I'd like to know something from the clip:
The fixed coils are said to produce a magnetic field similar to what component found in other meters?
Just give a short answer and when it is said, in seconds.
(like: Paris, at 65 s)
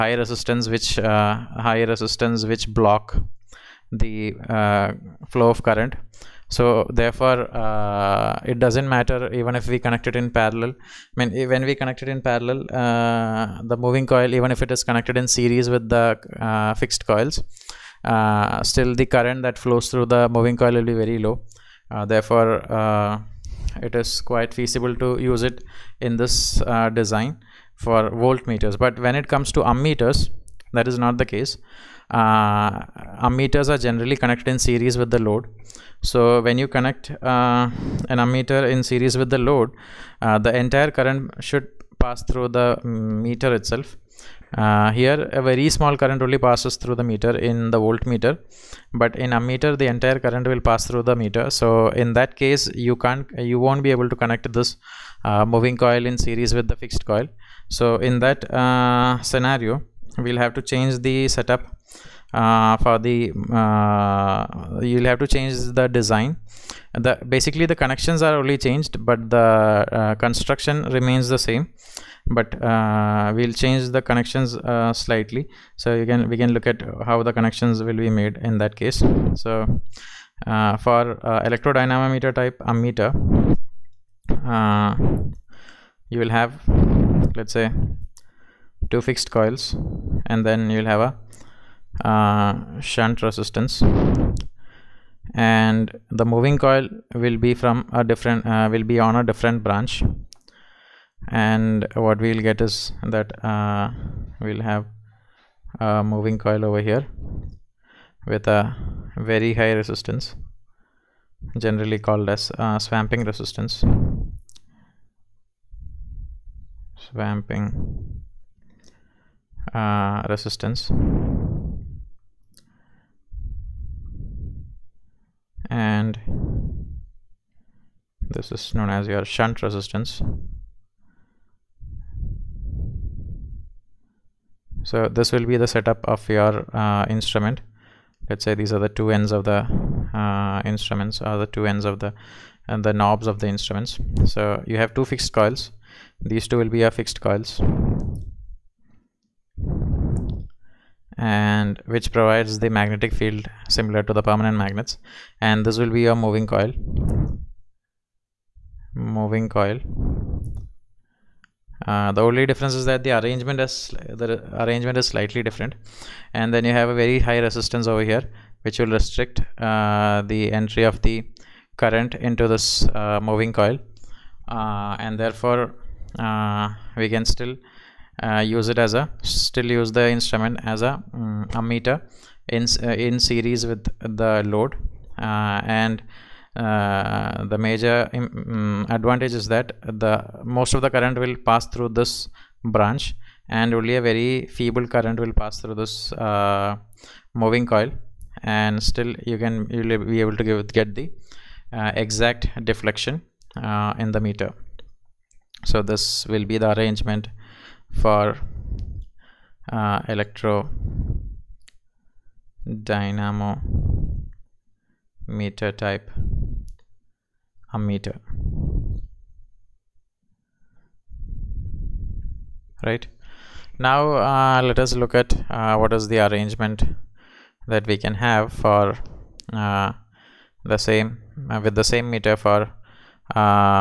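Permanent magnets, at 154 s.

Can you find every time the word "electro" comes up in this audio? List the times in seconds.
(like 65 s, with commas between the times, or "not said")
210 s.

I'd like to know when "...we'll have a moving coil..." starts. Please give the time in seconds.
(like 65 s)
104 s.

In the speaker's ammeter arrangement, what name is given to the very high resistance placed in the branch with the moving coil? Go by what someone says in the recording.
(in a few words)
Swamping resistance.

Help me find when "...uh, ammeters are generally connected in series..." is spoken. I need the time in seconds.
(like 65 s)
32 s.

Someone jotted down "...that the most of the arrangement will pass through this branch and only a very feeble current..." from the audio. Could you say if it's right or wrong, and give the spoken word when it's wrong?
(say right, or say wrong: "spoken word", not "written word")
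wrong: "current", not "arrangement".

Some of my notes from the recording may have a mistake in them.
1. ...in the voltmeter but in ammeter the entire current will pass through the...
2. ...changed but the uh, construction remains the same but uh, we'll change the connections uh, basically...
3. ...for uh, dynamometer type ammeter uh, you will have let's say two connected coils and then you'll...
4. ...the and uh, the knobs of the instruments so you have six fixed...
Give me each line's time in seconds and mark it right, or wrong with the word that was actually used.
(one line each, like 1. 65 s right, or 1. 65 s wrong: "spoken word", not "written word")
1. 47 s right
2. 68 s wrong: "slightly", not "basically"
3. 80 s wrong: "fixed", not "connected"
4. 141 s wrong: "two", not "six".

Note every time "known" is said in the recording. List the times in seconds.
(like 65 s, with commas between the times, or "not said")
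128 s.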